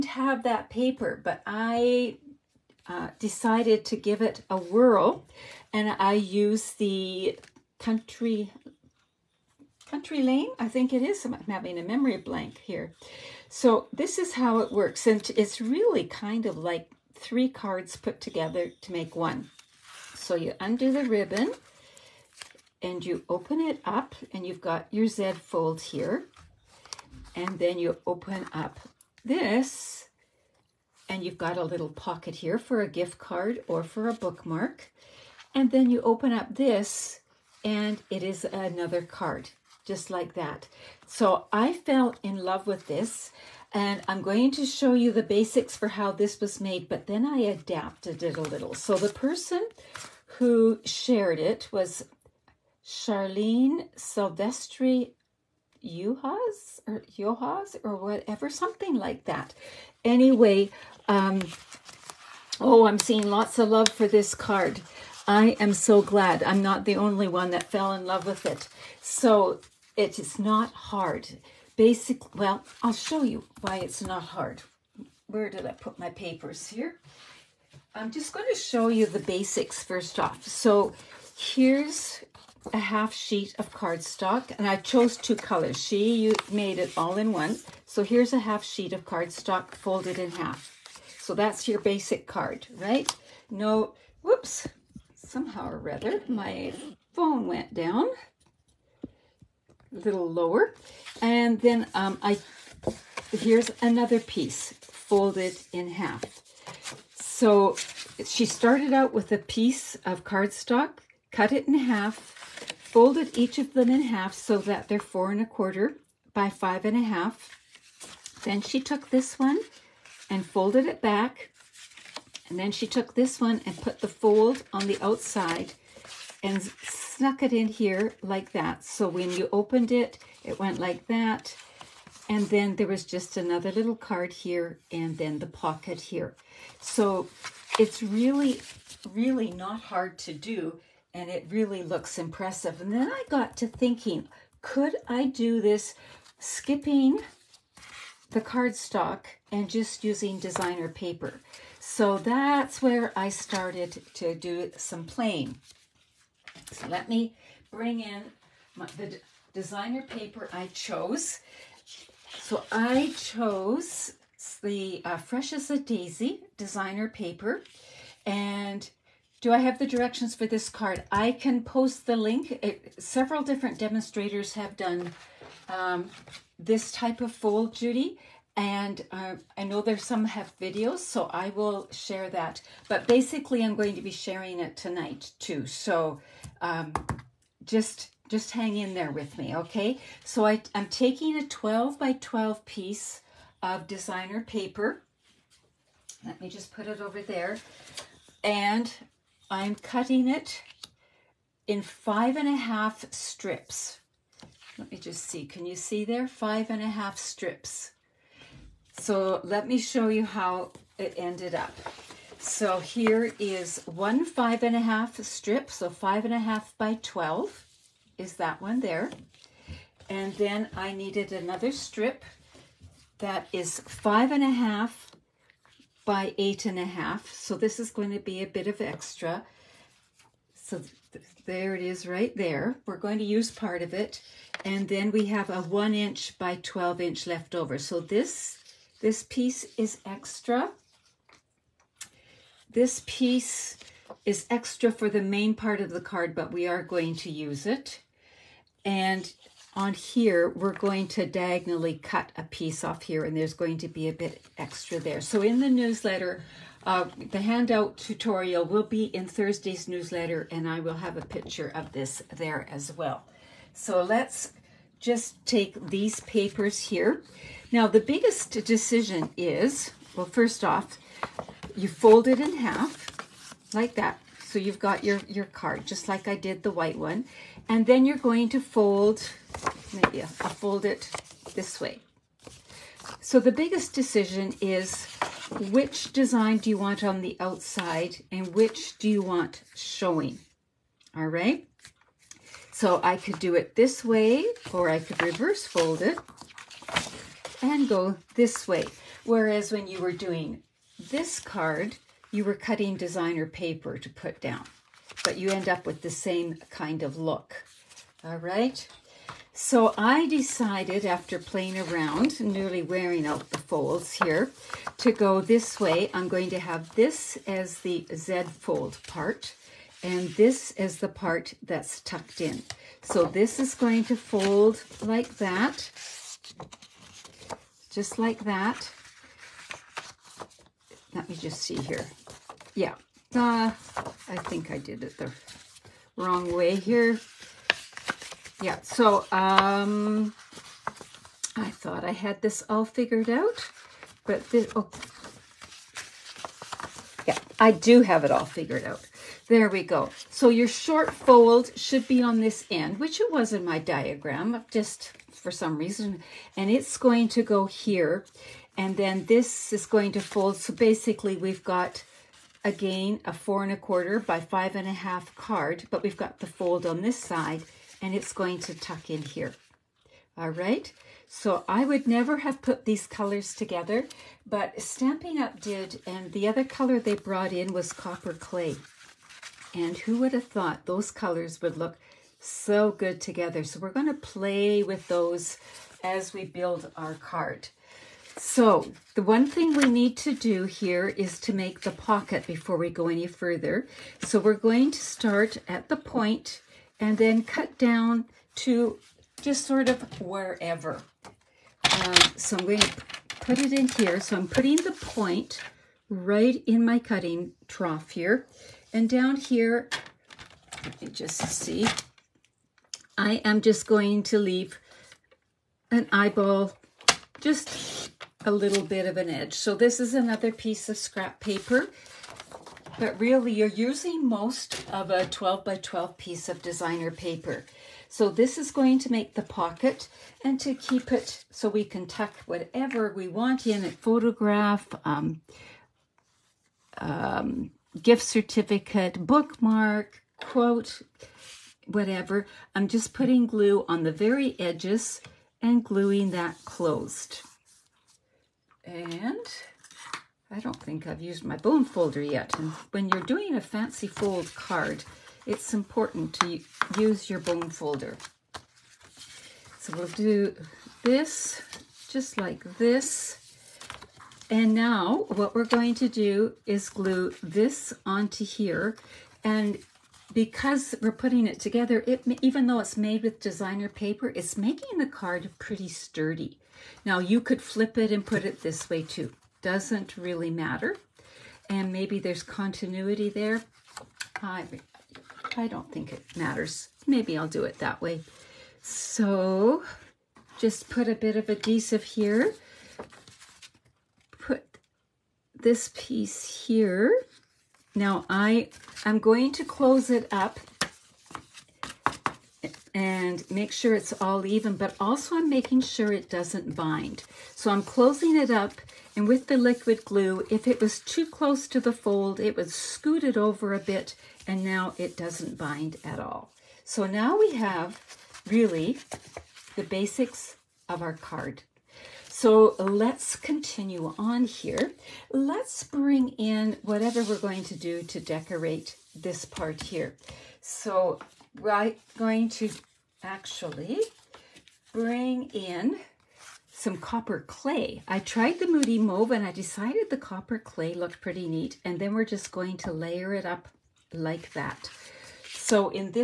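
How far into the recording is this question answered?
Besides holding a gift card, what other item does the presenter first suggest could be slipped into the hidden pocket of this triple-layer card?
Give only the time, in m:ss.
0:34.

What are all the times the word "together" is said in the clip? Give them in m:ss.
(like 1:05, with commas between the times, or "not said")
0:18, 6:13, 6:23, 7:51.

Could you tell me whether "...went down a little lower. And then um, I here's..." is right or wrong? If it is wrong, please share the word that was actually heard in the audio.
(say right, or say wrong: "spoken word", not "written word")
right.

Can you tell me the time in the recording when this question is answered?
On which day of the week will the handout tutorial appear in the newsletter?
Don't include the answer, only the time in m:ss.
4:19.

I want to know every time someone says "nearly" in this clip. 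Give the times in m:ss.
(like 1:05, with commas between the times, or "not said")
5:12.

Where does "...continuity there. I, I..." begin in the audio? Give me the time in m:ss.
8:02.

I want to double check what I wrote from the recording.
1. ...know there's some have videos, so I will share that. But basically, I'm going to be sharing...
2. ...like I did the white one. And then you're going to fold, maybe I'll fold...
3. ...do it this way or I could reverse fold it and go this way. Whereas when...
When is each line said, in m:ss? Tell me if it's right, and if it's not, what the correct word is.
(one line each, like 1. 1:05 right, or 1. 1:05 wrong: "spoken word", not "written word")
1. 2:59 right
2. 4:36 right
3. 4:53 right.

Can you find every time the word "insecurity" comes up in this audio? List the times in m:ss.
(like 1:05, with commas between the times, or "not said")
not said.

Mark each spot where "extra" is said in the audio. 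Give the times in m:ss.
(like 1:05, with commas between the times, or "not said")
3:48, 4:00, 4:04, 4:14.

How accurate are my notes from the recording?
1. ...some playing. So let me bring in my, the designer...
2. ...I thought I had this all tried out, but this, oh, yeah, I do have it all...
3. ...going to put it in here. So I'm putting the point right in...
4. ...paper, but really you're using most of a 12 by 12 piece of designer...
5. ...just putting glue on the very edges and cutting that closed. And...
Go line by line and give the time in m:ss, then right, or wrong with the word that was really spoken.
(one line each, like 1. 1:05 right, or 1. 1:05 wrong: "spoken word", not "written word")
1. 2:34 right
2. 5:41 wrong: "figured", not "tried"
3. 6:42 right
4. 7:01 right
5. 7:22 wrong: "gluing", not "cutting".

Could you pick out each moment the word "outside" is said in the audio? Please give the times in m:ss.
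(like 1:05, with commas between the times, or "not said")
2:05, 4:47.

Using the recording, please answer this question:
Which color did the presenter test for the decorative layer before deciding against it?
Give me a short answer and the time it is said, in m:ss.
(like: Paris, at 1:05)
Moody Mauve, at 8:58.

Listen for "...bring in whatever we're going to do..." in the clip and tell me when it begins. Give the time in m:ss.
8:45.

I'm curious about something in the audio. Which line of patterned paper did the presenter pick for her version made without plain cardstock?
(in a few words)
Fresh as a Daisy.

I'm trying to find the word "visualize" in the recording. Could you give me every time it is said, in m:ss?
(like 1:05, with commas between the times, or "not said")
not said.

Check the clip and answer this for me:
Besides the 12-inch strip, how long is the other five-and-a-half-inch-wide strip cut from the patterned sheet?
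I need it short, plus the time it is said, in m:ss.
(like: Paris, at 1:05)
8½ inches, at 3:46.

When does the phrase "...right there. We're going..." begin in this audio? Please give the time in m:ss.
3:52.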